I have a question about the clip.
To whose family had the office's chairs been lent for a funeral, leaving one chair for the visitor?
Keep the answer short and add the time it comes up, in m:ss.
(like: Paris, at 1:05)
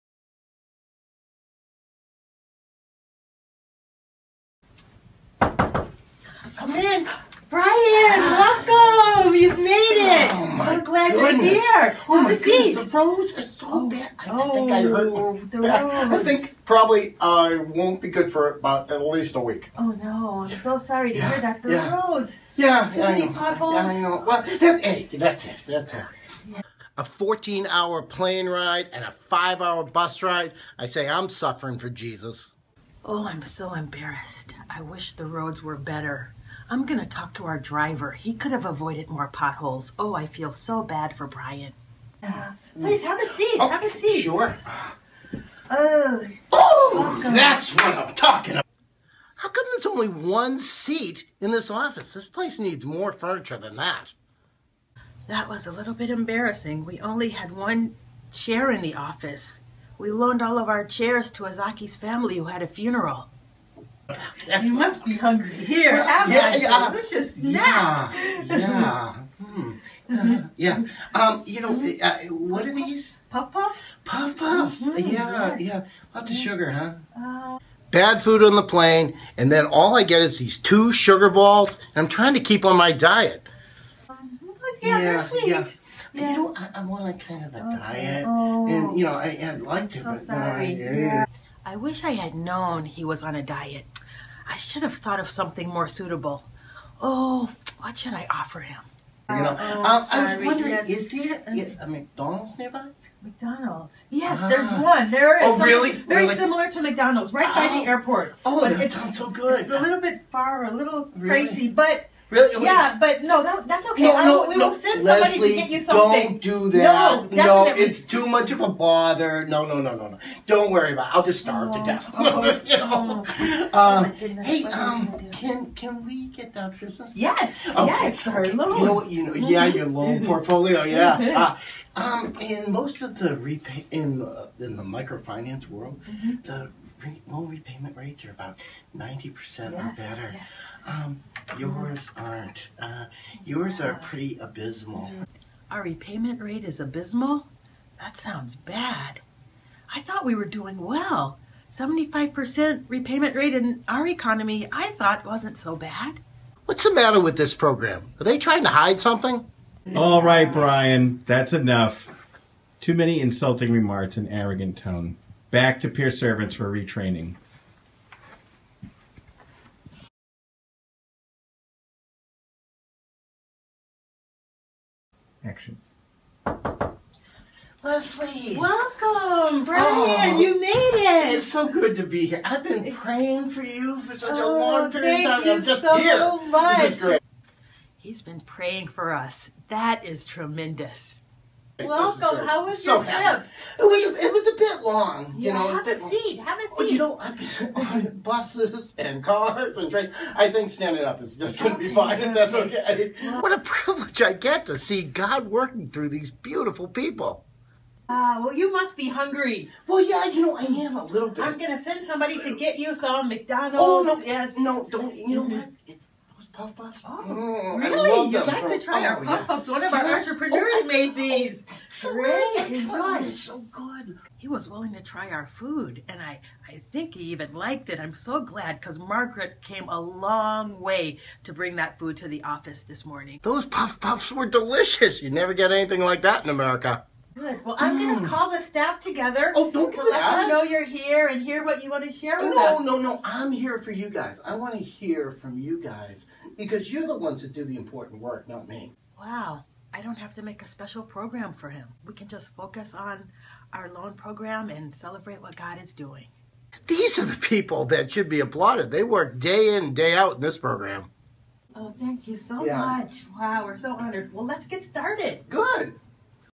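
Azaki's family, at 1:01.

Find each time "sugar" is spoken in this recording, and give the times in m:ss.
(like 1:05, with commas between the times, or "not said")
1:16, 1:20.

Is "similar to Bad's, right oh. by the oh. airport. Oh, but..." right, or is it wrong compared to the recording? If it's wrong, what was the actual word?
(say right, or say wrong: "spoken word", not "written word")
wrong: "McDonald", not "Bad".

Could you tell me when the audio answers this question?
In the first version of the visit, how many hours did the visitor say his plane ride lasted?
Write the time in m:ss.
0:27.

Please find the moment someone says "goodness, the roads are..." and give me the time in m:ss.
0:12.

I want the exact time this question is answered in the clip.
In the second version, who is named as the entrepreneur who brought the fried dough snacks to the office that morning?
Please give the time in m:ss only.
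3:48.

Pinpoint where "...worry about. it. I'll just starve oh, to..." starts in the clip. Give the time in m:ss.
2:00.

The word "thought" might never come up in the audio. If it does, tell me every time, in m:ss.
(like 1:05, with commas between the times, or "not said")
1:34, 2:30, 2:34.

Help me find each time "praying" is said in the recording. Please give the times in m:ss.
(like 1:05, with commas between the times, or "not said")
3:02, 3:08.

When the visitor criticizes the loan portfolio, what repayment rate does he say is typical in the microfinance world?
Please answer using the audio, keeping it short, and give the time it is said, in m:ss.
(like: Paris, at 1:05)
90%, at 2:18.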